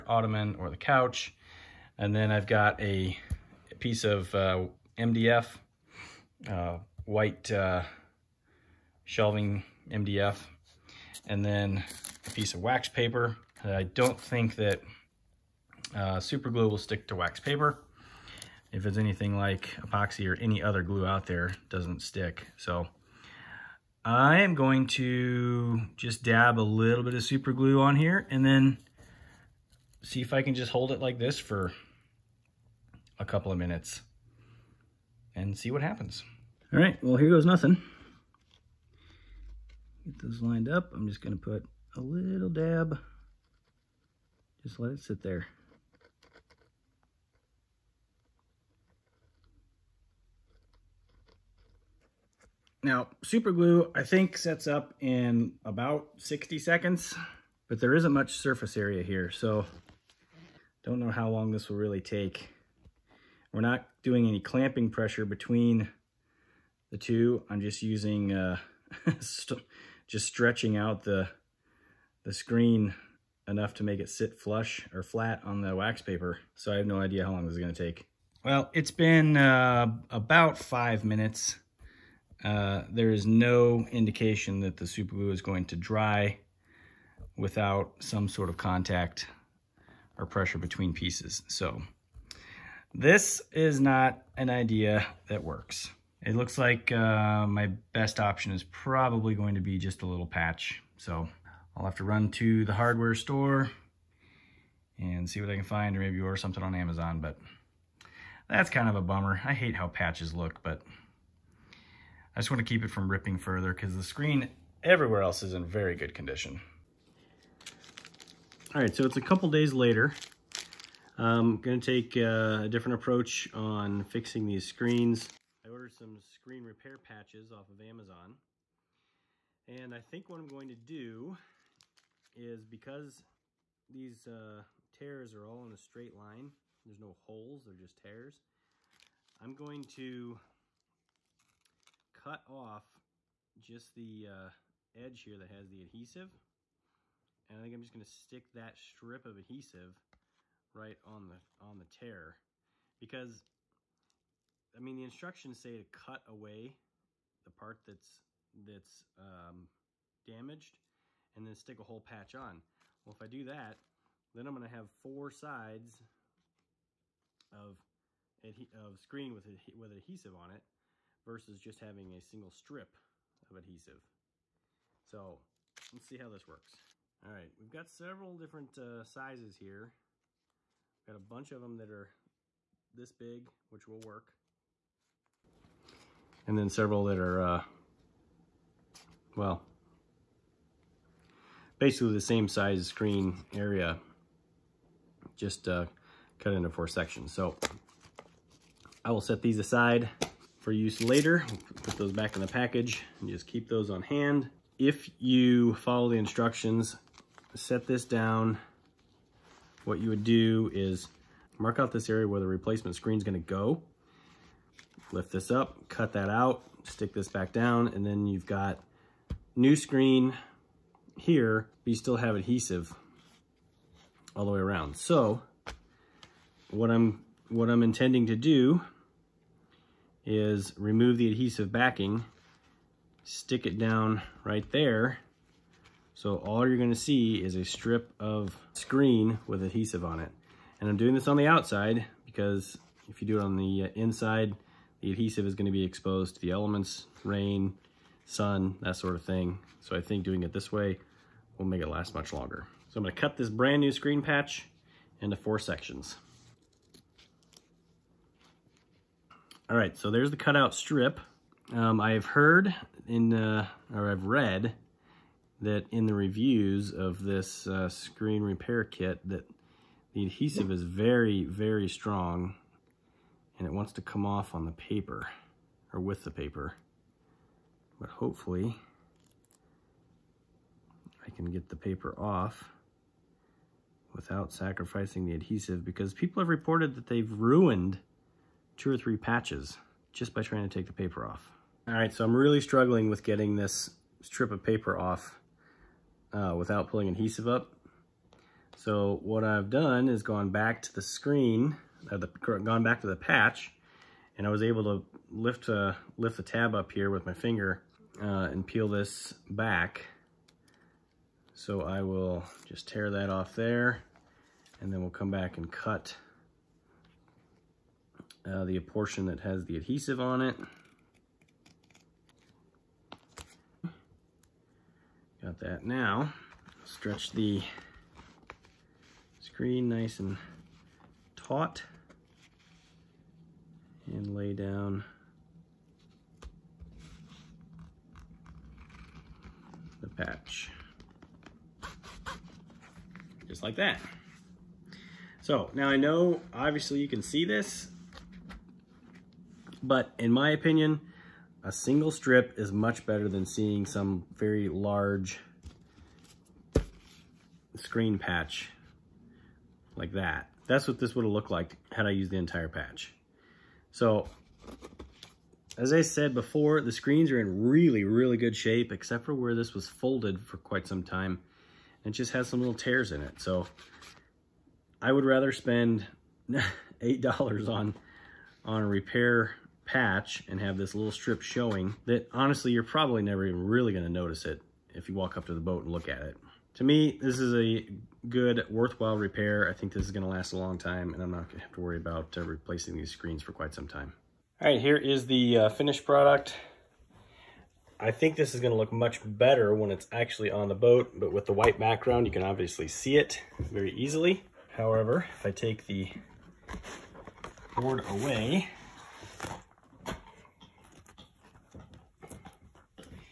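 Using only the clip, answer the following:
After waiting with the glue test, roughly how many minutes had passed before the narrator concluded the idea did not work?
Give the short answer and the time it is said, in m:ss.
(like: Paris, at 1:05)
5, at 1:20.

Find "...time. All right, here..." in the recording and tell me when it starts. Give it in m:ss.
6:33.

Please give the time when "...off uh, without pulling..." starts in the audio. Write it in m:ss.
4:54.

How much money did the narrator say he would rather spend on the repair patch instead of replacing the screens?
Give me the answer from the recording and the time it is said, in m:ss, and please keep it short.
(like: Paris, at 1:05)
$8, at 6:16.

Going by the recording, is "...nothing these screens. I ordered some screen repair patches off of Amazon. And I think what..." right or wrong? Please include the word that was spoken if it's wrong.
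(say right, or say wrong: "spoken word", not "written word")
wrong: "fixing", not "nothing".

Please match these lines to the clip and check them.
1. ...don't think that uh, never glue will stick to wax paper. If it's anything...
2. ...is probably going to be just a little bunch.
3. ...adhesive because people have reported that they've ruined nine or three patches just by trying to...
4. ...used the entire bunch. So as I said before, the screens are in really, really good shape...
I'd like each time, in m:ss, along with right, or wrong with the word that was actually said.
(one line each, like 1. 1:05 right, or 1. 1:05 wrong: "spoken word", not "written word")
1. 0:13 wrong: "super", not "never"
2. 1:38 wrong: "patch", not "bunch"
3. 4:45 wrong: "two", not "nine"
4. 6:02 wrong: "patch", not "bunch".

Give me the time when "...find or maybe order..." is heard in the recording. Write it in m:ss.
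1:45.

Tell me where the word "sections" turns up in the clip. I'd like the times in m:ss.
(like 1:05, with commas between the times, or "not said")
3:16, 4:15.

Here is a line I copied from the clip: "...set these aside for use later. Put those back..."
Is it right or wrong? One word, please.
right.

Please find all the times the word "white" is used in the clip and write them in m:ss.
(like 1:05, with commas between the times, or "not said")
0:07, 6:41.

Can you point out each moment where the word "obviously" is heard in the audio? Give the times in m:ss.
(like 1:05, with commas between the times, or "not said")
5:46, 6:42.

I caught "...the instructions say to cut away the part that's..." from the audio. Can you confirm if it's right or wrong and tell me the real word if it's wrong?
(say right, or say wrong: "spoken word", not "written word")
right.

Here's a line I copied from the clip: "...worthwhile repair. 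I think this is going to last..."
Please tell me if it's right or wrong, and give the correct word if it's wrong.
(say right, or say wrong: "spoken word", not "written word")
right.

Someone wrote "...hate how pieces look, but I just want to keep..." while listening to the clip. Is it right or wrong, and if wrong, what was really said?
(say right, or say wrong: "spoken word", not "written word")
wrong: "patches", not "pieces".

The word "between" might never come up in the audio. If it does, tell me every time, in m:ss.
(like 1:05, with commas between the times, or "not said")
1:05, 1:30.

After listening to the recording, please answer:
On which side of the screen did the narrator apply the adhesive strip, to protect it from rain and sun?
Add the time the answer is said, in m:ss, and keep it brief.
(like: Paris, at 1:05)
the outside, at 4:01.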